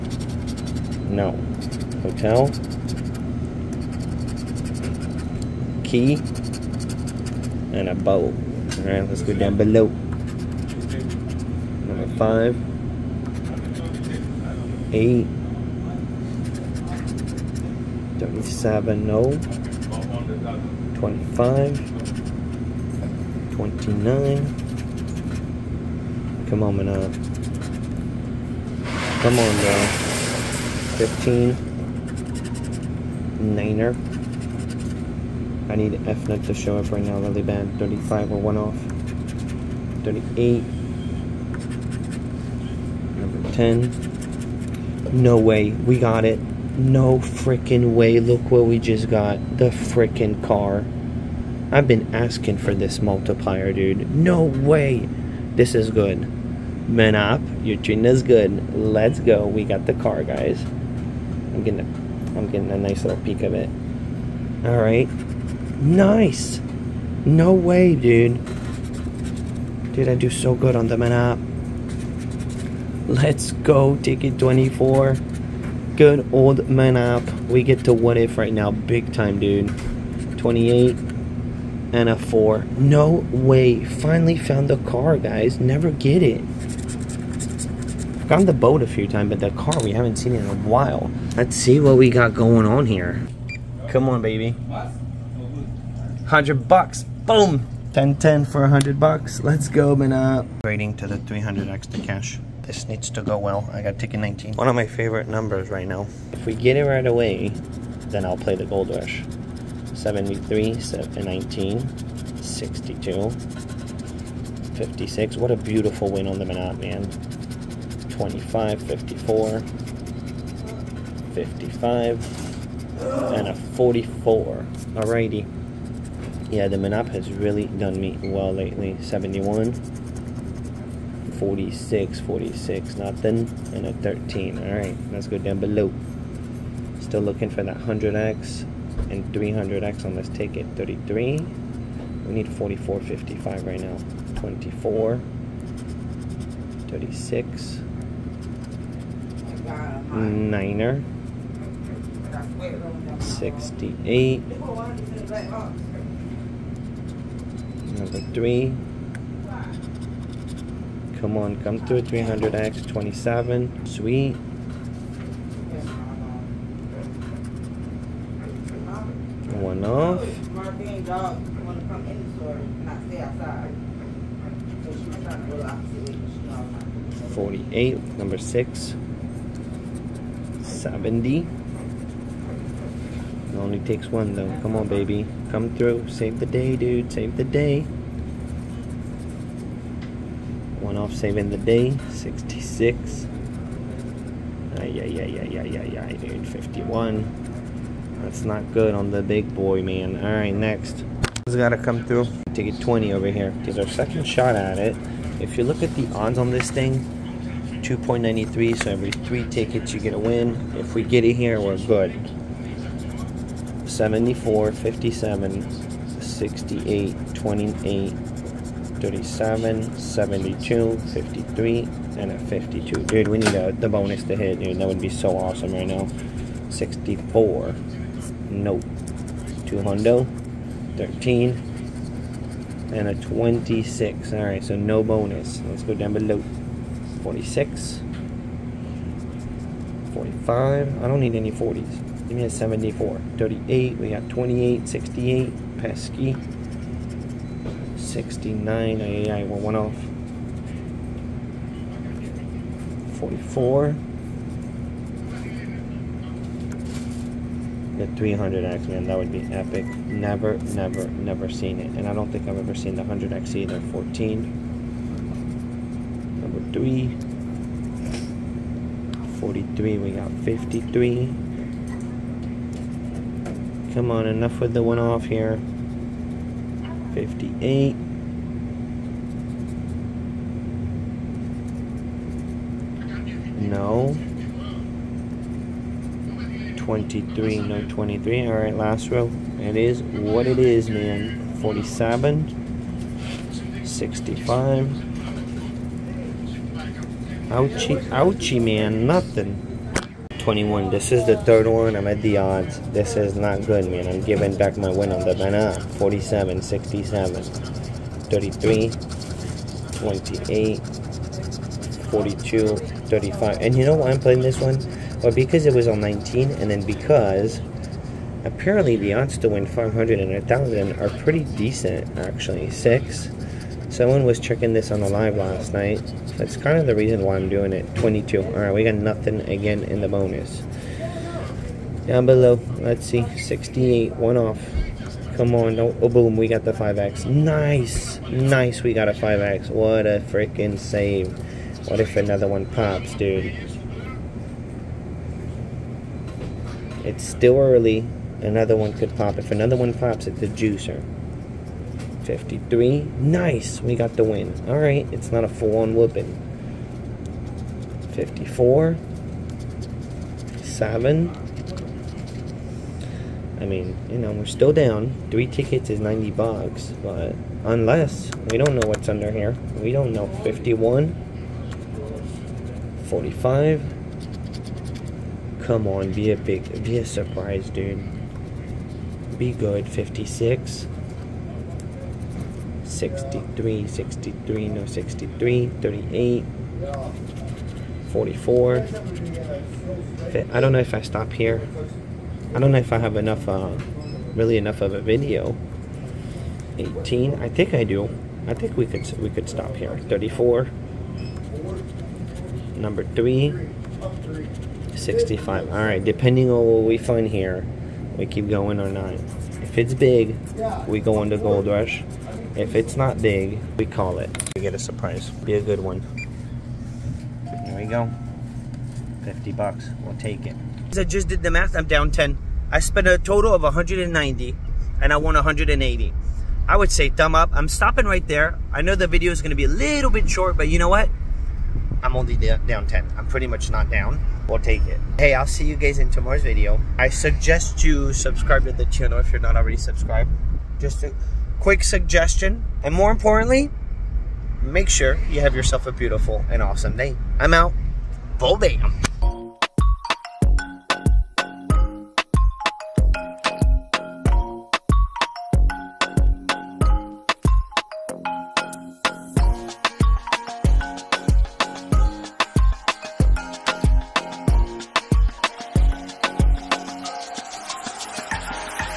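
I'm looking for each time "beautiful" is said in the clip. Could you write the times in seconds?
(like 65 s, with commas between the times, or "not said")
115 s, 445 s.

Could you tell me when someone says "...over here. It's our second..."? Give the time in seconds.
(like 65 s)
203 s.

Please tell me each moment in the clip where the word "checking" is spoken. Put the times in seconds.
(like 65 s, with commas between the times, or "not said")
324 s.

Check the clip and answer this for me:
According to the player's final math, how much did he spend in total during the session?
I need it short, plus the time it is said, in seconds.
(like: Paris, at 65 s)
$190, at 423 s.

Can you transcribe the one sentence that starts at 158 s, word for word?
Number three, Come on, come through.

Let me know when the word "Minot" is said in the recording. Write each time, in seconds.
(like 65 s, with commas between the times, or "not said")
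116 s.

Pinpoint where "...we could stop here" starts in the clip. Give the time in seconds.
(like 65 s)
399 s.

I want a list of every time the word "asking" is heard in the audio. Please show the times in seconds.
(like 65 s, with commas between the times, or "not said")
52 s.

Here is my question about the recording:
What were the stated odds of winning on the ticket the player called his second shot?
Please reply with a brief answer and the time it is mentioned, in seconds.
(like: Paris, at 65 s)
2.93, at 207 s.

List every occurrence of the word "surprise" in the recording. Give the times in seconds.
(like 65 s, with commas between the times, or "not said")
377 s, 414 s.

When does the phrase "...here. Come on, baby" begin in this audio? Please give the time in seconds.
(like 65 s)
92 s.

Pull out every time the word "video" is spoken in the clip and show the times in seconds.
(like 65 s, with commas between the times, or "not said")
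395 s, 429 s, 436 s.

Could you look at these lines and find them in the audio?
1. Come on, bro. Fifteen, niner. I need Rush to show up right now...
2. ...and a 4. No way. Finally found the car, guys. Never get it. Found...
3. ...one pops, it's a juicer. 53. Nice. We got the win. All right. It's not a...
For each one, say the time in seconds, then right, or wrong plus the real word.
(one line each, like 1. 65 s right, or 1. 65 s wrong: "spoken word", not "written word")
1. 29 s wrong: "Fnet", not "Rush"
2. 81 s right
3. 349 s right.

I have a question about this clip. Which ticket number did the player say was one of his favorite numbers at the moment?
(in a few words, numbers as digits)
19.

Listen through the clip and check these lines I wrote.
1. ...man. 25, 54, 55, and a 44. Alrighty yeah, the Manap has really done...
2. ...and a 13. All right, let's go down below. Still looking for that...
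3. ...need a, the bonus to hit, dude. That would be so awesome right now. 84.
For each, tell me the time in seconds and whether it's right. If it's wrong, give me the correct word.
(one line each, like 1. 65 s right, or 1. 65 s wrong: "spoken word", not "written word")
1. 116 s right
2. 133 s right
3. 223 s wrong: "64", not "84".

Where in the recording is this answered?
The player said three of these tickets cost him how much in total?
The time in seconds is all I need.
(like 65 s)
366 s.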